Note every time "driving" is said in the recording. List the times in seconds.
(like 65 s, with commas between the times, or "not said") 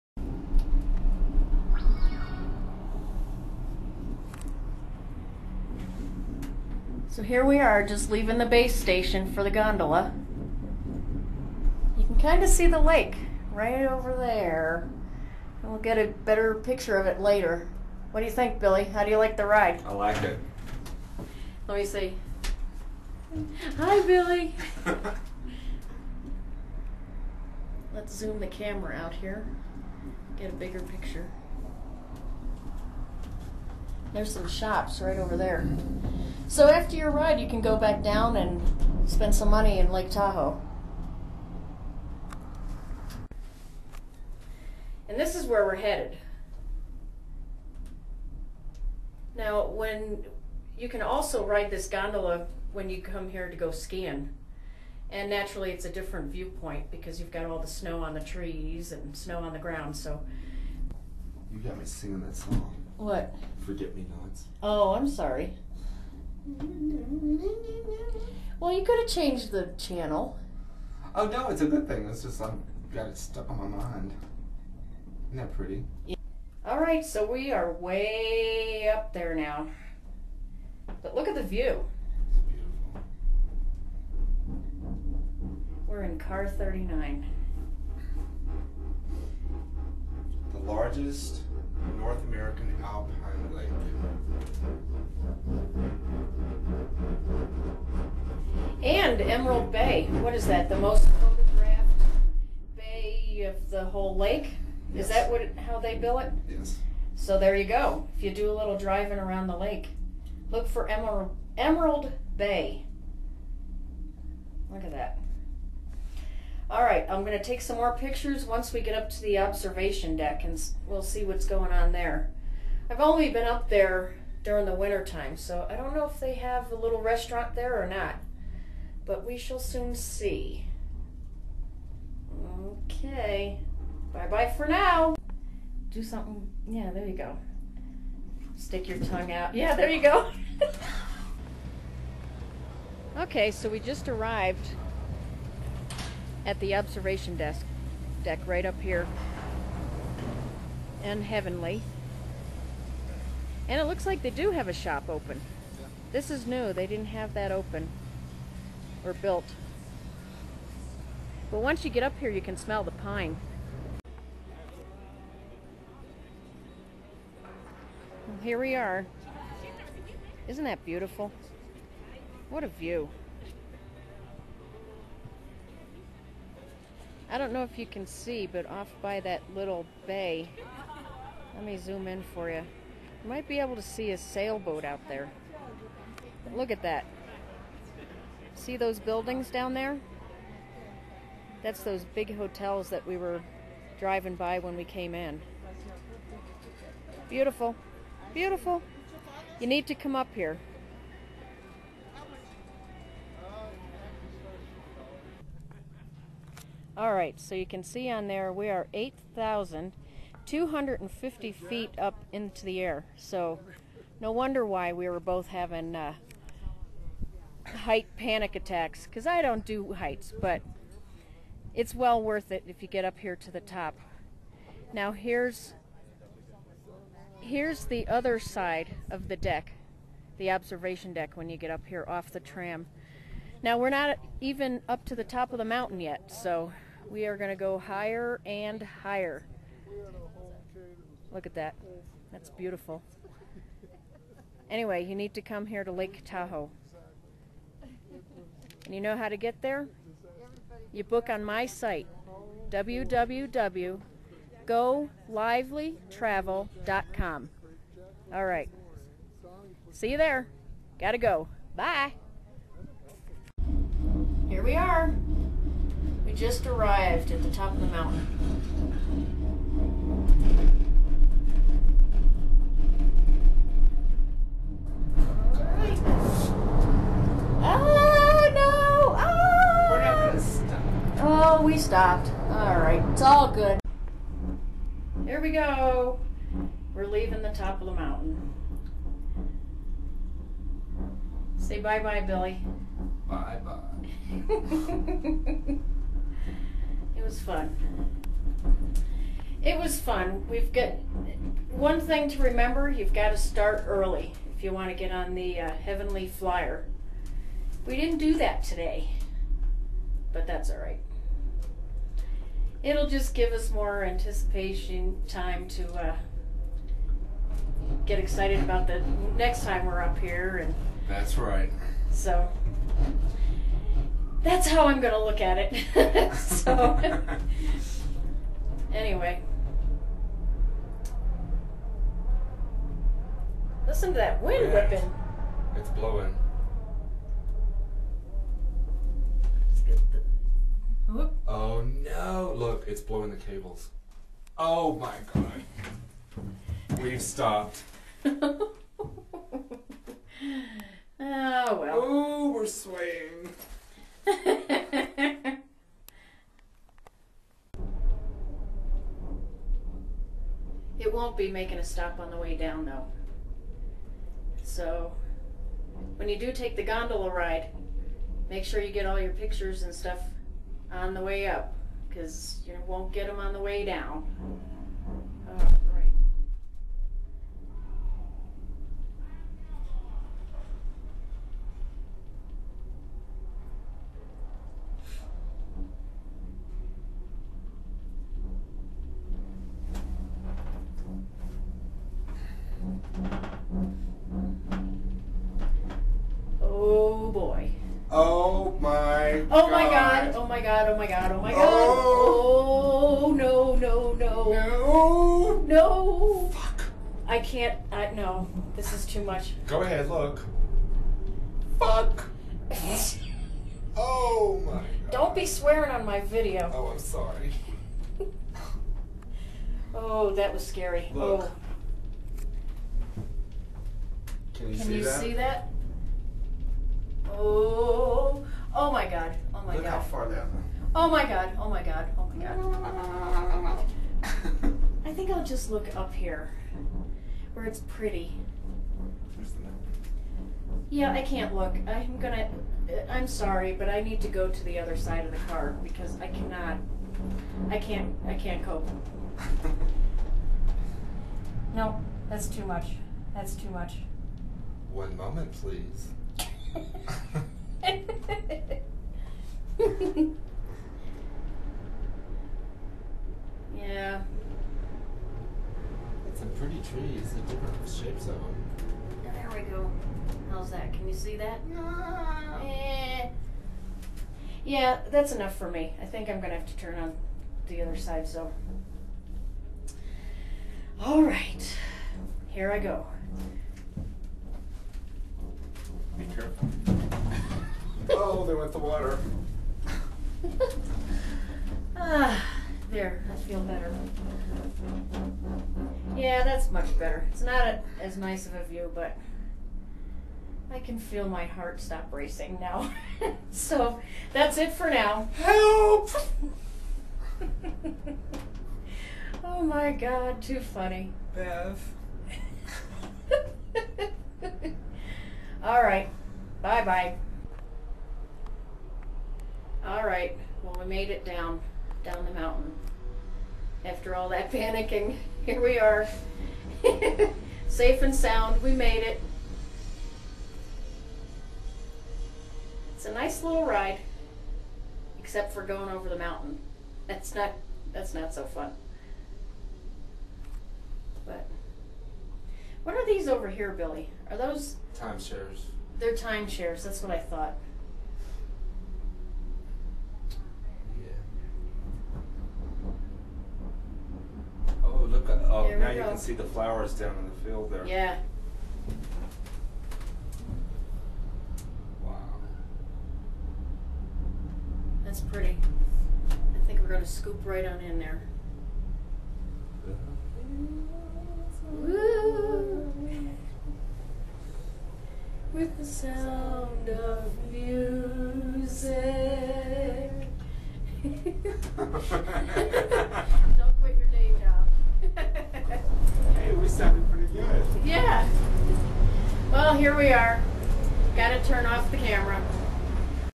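108 s, 193 s.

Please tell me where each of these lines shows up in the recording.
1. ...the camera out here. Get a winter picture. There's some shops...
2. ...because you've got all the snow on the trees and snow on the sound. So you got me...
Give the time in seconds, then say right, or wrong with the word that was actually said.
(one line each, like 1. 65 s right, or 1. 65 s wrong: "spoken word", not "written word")
1. 28 s wrong: "bigger", not "winter"
2. 56 s wrong: "ground", not "sound".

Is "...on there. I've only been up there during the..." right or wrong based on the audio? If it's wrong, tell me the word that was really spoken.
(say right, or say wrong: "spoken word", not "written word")
right.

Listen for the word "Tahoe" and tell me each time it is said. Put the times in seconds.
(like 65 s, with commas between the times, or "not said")
40 s, 246 s.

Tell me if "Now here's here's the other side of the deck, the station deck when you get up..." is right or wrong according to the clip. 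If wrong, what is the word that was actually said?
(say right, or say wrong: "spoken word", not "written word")
wrong: "observation", not "station".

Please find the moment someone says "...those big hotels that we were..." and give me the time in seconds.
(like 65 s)
191 s.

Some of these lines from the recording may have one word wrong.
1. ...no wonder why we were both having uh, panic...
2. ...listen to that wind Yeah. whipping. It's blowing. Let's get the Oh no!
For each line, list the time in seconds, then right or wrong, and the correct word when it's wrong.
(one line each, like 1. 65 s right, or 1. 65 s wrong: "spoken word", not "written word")
1. 214 s right
2. 333 s right.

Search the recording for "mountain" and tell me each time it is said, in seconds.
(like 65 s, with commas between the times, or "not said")
235 s, 267 s, 287 s, 522 s, 536 s.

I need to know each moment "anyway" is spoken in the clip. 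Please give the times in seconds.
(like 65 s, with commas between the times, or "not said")
244 s, 328 s.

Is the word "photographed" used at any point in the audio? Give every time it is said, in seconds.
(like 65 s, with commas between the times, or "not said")
101 s.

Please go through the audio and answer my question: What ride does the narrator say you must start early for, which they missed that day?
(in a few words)
Heavenly Flyer.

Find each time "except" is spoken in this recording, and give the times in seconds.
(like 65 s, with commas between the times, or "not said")
535 s.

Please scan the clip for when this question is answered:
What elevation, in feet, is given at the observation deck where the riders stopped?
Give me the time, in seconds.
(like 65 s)
208 s.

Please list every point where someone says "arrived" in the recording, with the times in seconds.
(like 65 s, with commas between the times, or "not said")
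144 s, 266 s.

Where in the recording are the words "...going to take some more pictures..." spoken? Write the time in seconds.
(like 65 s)
117 s.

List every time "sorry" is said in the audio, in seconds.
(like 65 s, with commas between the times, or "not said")
65 s, 416 s, 443 s.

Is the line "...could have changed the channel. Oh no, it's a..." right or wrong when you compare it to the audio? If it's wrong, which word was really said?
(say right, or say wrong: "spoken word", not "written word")
right.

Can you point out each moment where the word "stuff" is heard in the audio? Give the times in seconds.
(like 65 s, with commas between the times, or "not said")
369 s.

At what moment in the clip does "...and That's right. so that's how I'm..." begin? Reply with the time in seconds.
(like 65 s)
320 s.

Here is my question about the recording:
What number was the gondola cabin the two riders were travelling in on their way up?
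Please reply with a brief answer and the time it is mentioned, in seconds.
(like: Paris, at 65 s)
39, at 86 s.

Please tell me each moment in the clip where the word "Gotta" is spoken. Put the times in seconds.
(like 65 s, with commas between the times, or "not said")
260 s.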